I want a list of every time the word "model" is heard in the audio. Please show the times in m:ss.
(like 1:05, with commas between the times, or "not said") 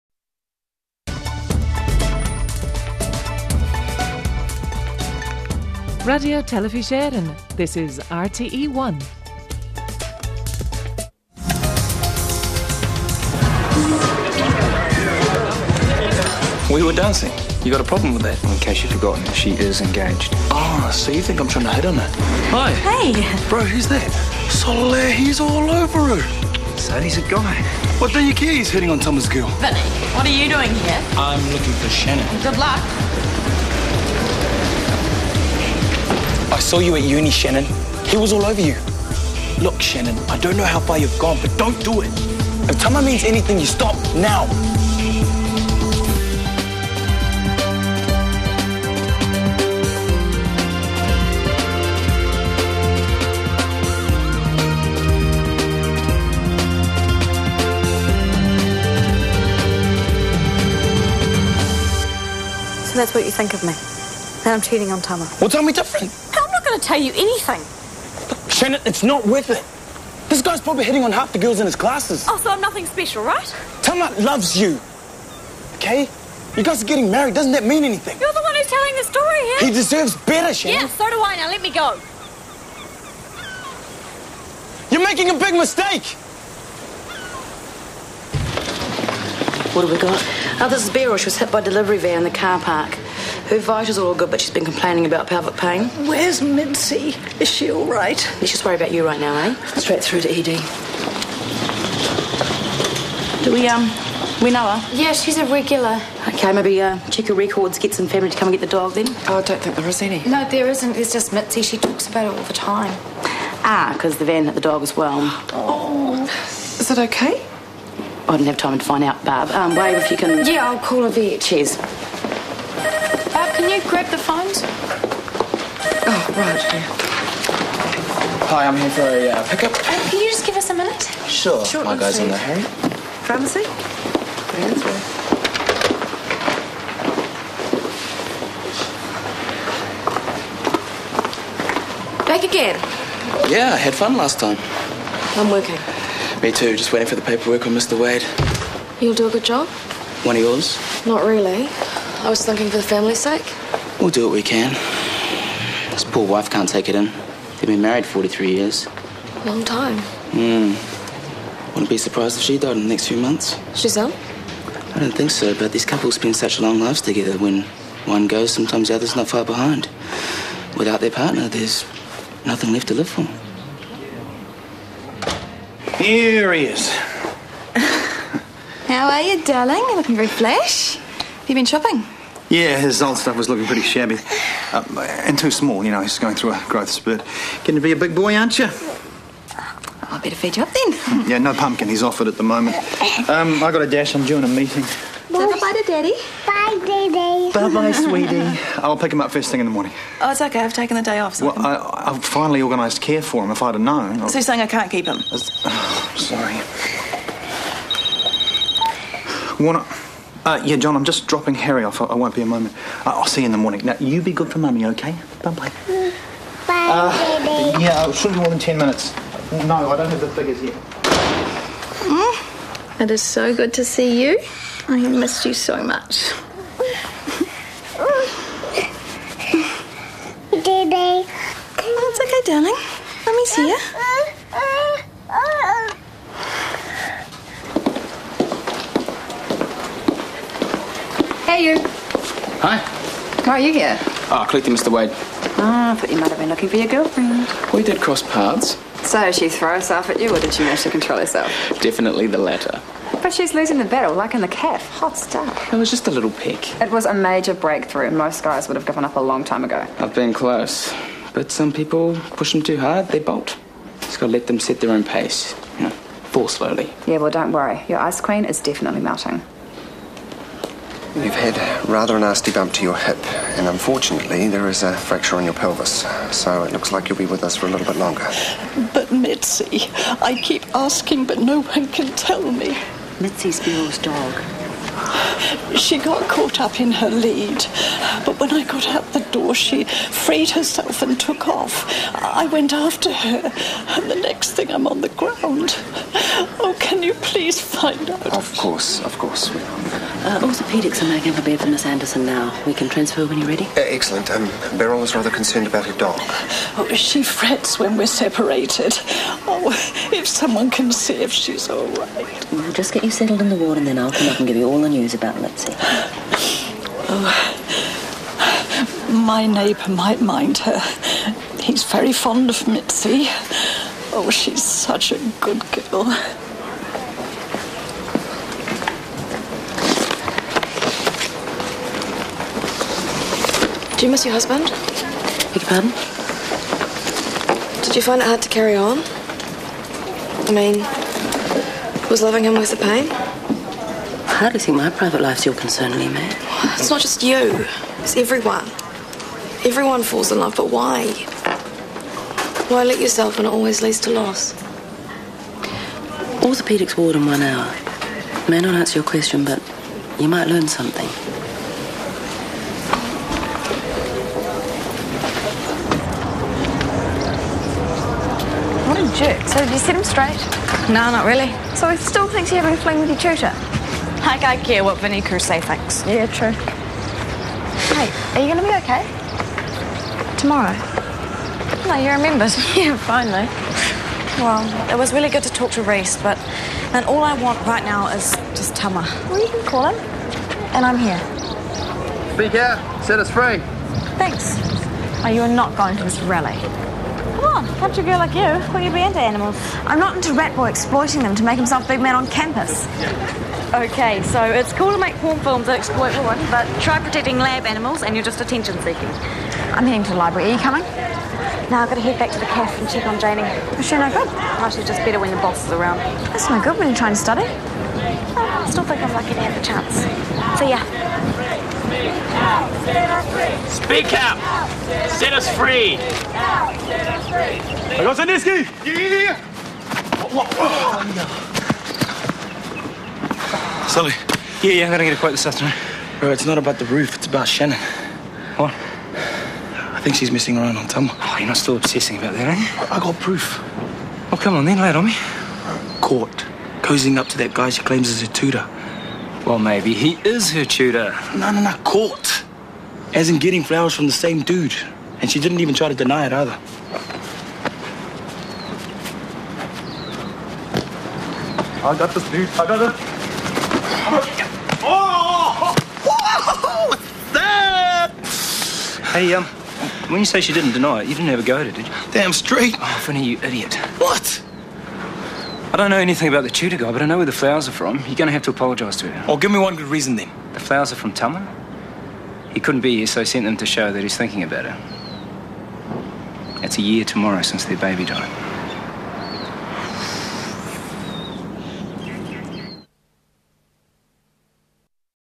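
not said.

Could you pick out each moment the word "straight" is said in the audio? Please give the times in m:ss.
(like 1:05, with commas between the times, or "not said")
1:39, 6:10, 7:52.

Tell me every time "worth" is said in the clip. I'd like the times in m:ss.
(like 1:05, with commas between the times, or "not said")
1:09, 5:42.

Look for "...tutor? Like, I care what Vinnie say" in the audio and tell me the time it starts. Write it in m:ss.
6:13.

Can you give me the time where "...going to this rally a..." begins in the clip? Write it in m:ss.
6:35.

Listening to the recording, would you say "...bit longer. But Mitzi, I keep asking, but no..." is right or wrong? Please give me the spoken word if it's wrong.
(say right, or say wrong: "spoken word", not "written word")
right.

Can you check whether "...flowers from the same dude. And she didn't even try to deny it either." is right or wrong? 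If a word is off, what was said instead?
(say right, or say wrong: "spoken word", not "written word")
right.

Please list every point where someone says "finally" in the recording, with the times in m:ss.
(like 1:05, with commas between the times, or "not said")
3:22, 6:22.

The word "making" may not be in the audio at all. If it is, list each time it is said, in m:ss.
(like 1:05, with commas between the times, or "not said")
1:25, 5:01.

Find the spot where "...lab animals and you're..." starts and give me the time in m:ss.
6:47.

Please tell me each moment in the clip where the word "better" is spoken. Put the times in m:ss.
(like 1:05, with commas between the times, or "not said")
1:20, 3:10, 6:55.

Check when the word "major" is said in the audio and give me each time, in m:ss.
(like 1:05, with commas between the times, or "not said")
4:17.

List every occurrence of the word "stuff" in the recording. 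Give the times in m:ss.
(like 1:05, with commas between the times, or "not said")
3:03, 4:15.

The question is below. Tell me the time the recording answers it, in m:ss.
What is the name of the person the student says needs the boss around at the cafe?
6:53.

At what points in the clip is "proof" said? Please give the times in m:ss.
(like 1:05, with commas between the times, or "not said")
7:23.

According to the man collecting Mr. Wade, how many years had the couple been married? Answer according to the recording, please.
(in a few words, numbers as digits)
43.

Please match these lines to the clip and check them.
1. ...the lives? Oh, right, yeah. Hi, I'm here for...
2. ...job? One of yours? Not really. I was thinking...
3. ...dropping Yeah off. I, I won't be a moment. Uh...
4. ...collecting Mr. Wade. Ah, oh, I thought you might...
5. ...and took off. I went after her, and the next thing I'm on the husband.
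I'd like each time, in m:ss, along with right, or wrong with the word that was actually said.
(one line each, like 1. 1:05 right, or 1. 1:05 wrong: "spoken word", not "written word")
1. 2:04 wrong: "phones", not "lives"
2. 2:29 right
3. 3:31 wrong: "Harry", not "Yeah"
4. 4:04 right
5. 4:51 wrong: "ground", not "husband".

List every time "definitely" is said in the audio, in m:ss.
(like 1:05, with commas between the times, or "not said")
4:11, 4:28.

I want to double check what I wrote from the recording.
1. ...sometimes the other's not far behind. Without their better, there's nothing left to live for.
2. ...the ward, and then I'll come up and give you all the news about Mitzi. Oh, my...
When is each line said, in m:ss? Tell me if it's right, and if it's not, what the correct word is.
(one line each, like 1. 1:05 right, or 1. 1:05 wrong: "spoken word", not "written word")
1. 2:48 wrong: "partner", not "better"
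2. 5:13 right.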